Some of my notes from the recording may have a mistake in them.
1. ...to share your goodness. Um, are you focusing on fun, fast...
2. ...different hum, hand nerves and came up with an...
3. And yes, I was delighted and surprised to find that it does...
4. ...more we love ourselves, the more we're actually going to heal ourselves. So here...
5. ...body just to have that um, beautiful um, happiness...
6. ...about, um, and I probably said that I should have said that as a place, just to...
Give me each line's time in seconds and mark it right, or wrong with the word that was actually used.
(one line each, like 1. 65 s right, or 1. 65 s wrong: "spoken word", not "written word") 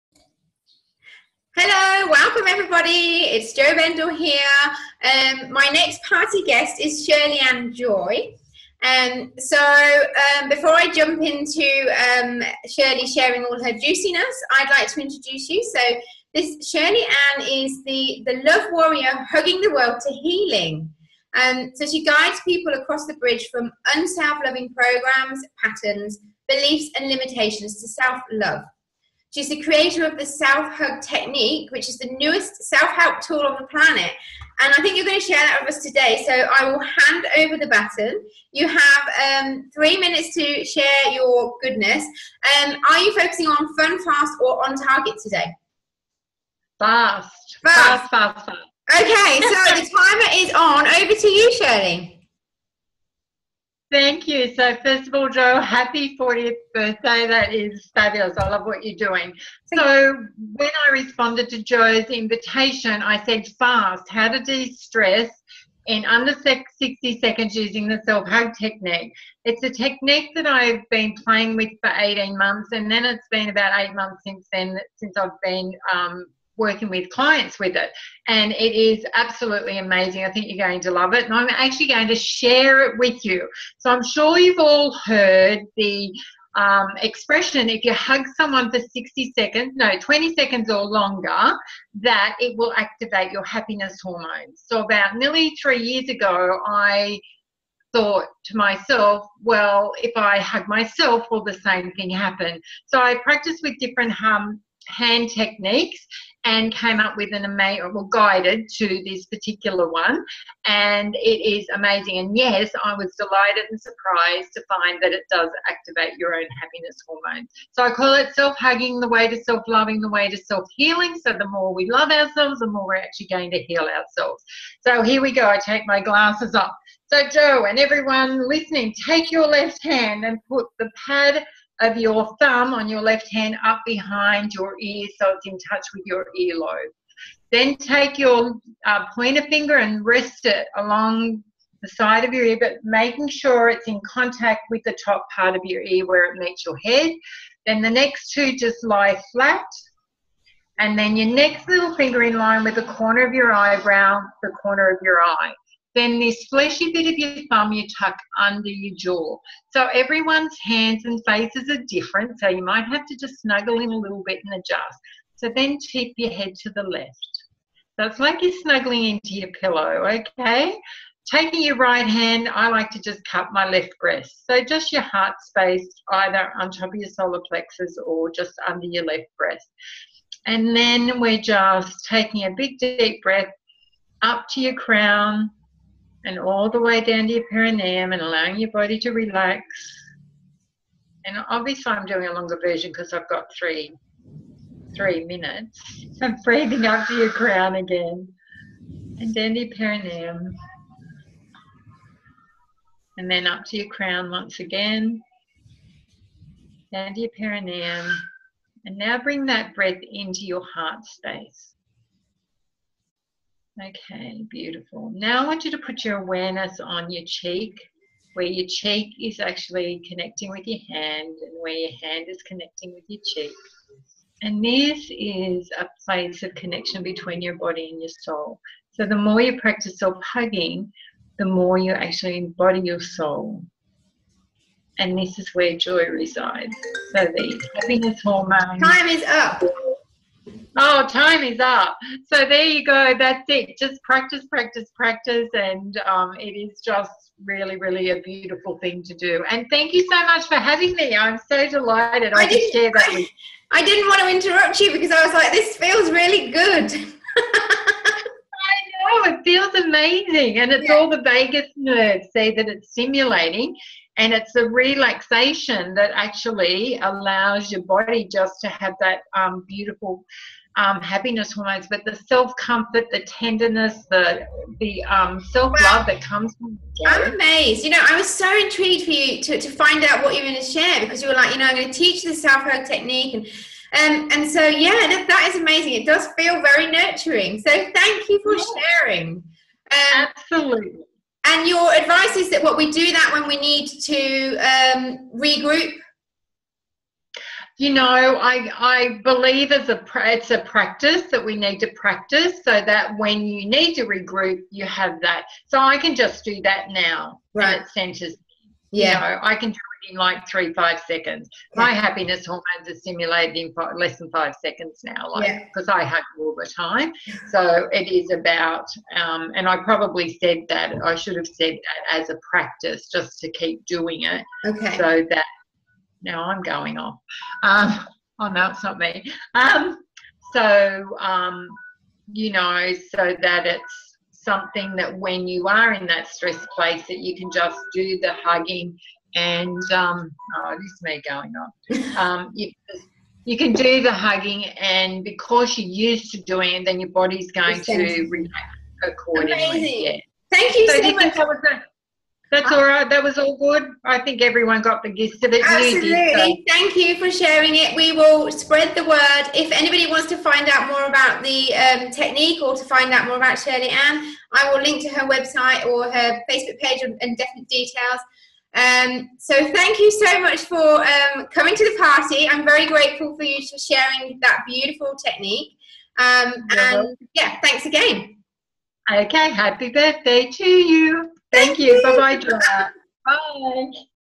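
1. 40 s right
2. 103 s wrong: "techniques", not "nerves"
3. 112 s right
4. 121 s right
5. 267 s right
6. 318 s wrong: "practice", not "place".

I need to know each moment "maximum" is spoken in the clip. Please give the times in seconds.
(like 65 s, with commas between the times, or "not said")
not said.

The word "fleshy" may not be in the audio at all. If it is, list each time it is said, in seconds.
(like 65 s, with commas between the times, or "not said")
156 s.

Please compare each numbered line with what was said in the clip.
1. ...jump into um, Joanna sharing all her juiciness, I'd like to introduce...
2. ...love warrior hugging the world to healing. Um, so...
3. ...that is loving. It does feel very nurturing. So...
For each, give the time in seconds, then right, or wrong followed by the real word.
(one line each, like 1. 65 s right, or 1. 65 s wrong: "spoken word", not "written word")
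1. 10 s wrong: "Shirley", not "Joanna"
2. 18 s right
3. 285 s wrong: "amazing", not "loving".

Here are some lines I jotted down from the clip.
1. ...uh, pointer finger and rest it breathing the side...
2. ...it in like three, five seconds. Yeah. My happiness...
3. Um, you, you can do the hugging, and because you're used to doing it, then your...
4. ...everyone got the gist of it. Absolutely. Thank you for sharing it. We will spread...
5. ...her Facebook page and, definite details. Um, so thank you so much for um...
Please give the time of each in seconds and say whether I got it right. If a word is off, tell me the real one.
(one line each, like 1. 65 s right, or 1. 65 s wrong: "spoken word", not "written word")
1. 138 s wrong: "along", not "breathing"
2. 309 s right
3. 342 s right
4. 354 s right
5. 366 s right.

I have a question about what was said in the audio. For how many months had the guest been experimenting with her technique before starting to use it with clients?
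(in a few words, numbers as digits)
18.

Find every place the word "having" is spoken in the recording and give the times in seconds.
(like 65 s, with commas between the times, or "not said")
250 s.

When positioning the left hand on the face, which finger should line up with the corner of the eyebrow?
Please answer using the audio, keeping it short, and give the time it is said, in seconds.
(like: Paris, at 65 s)
little finger, at 151 s.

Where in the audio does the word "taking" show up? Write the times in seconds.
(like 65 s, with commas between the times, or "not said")
171 s, 182 s.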